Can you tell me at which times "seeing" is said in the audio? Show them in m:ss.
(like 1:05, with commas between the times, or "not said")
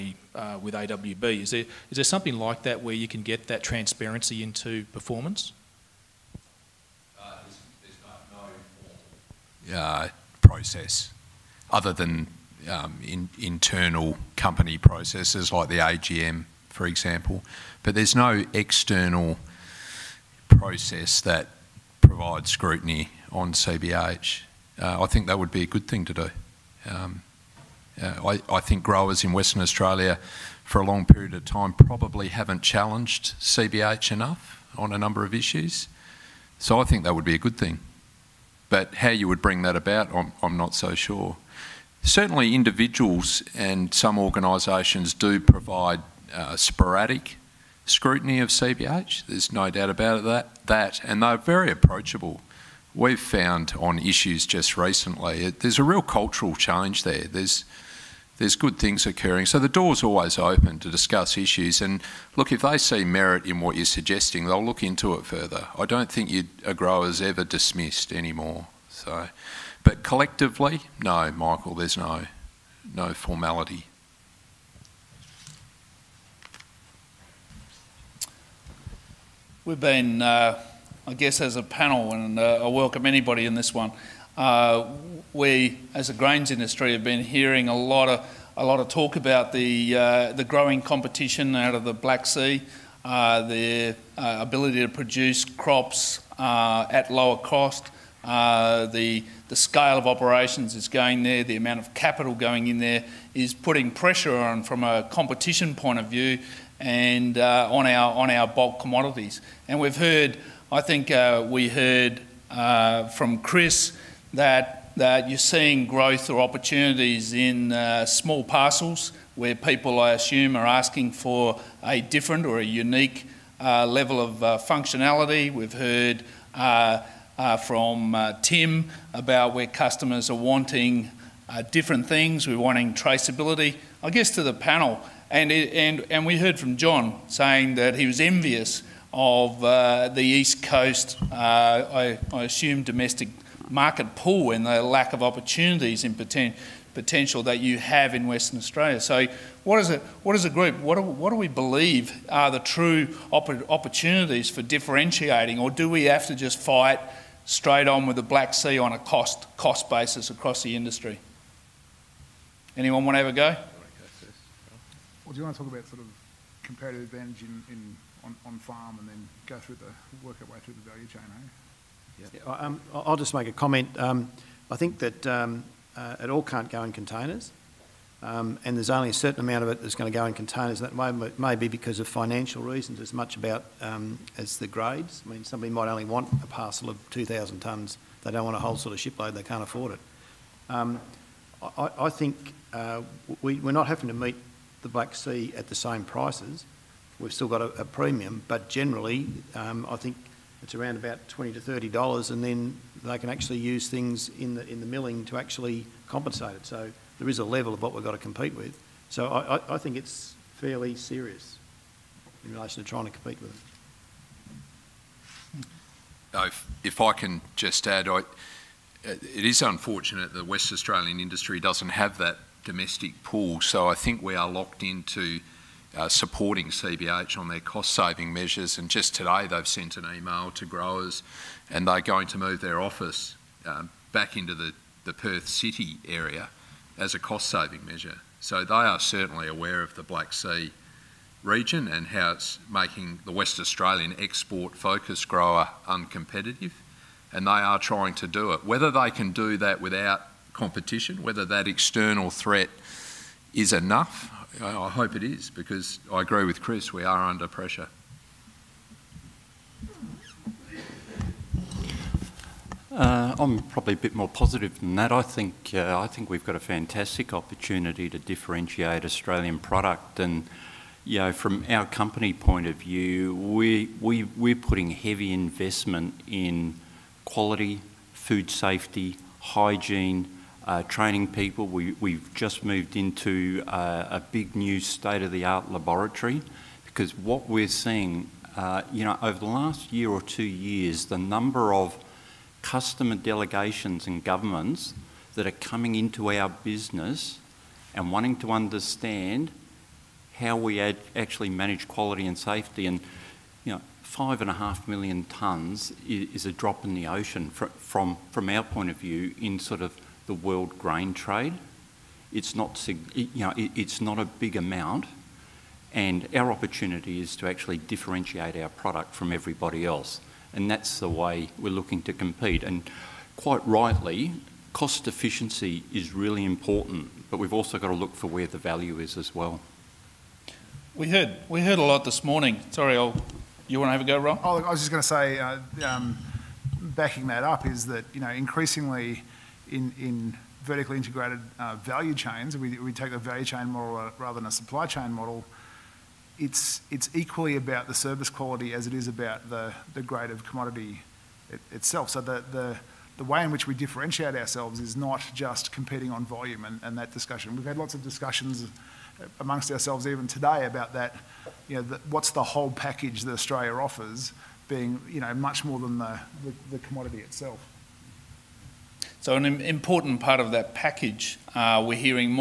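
1:55, 4:47.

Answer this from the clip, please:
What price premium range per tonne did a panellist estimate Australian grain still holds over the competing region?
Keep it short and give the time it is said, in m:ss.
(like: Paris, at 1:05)
$20 to $30, at 3:21.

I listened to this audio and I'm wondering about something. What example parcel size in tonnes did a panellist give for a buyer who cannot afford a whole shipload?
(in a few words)
2,000 tonnes.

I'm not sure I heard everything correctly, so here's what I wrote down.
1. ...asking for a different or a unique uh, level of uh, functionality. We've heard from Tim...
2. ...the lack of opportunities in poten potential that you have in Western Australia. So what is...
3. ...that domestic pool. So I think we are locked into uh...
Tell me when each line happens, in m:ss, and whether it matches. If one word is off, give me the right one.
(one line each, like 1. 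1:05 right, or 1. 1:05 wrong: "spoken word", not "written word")
1. 2:00 right
2. 2:24 right
3. 3:42 right.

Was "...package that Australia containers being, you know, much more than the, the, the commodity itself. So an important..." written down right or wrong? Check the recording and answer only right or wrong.
wrong.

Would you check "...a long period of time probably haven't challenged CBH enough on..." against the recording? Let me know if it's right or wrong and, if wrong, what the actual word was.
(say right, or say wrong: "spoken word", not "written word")
right.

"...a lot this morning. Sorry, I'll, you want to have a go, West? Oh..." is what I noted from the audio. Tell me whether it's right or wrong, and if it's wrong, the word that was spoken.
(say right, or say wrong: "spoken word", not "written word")
wrong: "Rob", not "West".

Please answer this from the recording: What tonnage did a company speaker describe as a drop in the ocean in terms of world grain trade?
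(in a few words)
5.5 million tonnes.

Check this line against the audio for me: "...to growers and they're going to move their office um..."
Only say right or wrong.
right.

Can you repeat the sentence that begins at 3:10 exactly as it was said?
Um, I, I, think uh, we, we're not having to meet the Black Sea at the same prices.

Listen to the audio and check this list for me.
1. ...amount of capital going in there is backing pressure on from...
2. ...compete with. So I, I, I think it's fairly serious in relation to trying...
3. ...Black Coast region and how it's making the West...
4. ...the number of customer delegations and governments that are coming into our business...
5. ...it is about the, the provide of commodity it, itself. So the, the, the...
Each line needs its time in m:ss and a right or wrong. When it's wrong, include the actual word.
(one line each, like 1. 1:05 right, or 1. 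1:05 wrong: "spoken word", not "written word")
1. 1:41 wrong: "putting", not "backing"
2. 3:28 right
3. 4:00 wrong: "Sea", not "Coast"
4. 4:51 right
5. 5:48 wrong: "grade", not "provide".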